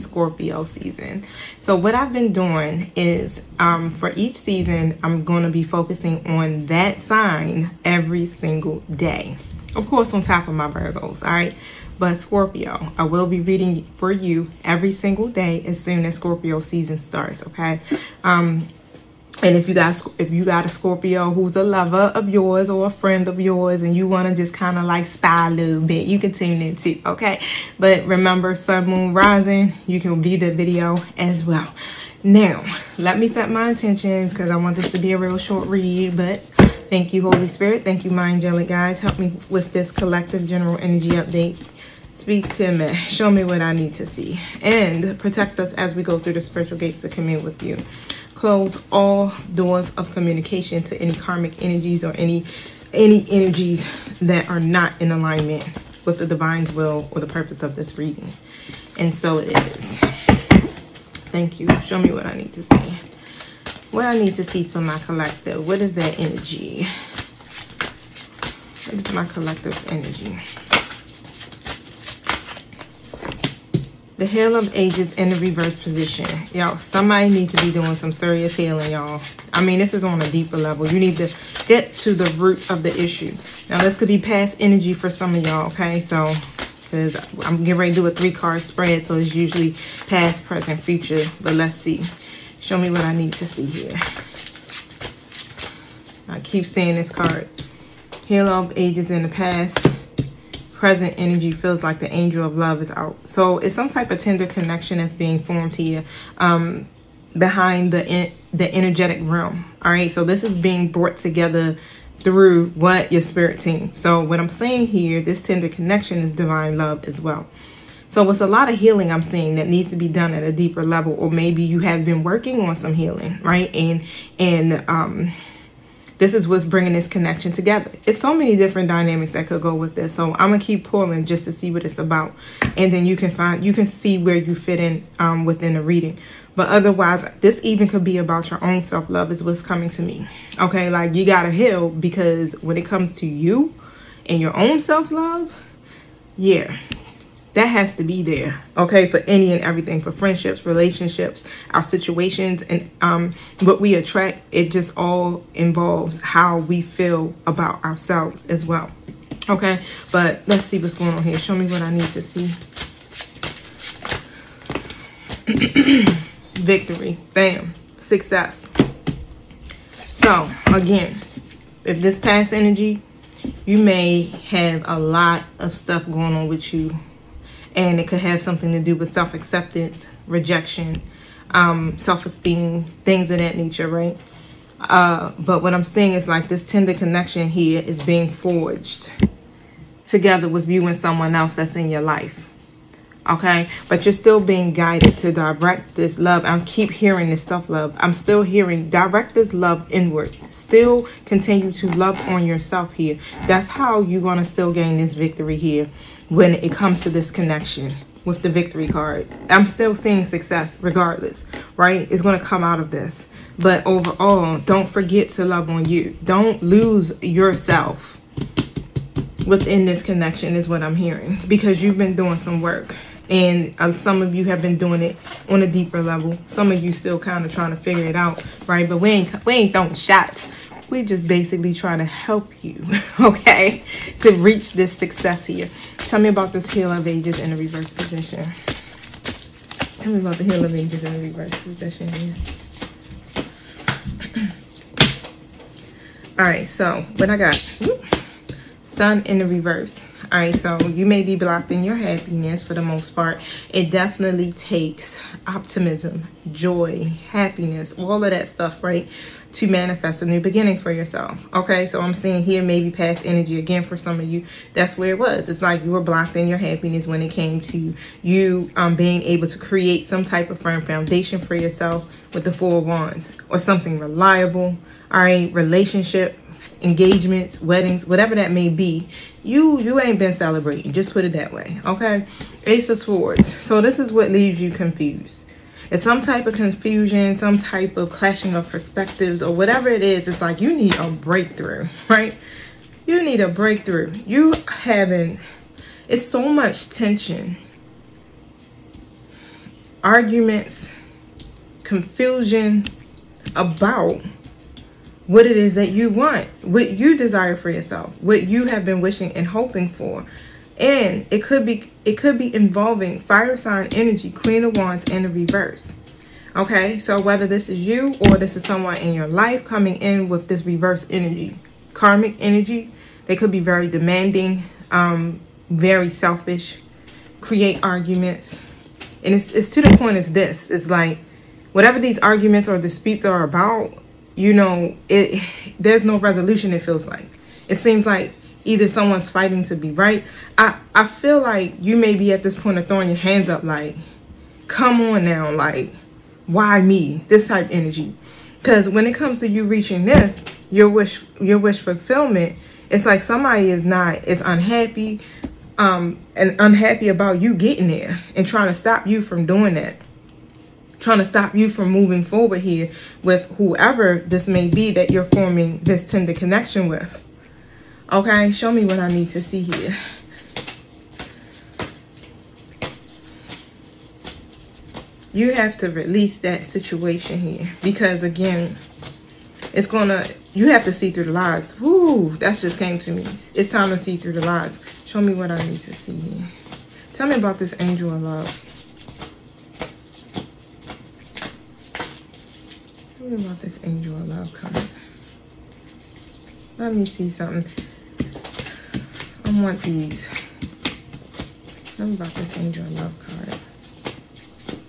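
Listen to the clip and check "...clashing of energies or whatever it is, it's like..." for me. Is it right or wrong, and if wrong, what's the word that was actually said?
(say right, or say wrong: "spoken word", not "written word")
wrong: "perspectives", not "energies".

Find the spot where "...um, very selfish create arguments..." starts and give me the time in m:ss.
5:24.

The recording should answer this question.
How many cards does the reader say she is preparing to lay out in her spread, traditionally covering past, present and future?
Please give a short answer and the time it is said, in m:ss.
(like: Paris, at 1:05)
3, at 1:28.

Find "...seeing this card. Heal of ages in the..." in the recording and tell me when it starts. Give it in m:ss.
1:36.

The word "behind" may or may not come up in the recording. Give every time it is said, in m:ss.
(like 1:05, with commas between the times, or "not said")
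1:47.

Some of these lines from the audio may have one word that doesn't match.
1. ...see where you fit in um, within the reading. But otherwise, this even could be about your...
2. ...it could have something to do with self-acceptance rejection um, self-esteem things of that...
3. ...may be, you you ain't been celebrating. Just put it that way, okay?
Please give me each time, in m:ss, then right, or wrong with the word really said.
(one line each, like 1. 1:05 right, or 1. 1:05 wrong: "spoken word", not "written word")
1. 2:13 right
2. 2:57 right
3. 4:38 right.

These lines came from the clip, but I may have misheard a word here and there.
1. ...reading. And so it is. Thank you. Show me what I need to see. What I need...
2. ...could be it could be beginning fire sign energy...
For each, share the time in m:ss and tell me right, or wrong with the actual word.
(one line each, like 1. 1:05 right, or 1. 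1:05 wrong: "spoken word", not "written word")
1. 0:57 right
2. 5:11 wrong: "involving", not "beginning".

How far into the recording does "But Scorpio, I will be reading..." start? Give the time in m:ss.
0:11.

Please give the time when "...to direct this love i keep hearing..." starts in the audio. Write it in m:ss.
3:15.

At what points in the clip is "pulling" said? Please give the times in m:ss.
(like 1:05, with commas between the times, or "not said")
2:10.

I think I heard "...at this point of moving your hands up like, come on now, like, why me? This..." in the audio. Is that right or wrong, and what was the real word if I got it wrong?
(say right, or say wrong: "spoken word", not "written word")
wrong: "throwing", not "moving".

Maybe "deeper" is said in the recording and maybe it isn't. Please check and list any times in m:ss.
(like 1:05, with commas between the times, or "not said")
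1:20, 2:00, 3:45.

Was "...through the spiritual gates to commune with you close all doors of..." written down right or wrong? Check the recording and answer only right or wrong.
right.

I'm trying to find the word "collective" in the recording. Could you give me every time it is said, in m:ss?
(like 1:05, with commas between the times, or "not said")
0:39, 1:04, 1:09.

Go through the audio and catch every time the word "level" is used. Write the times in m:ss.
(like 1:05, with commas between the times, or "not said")
1:20, 2:00, 3:46.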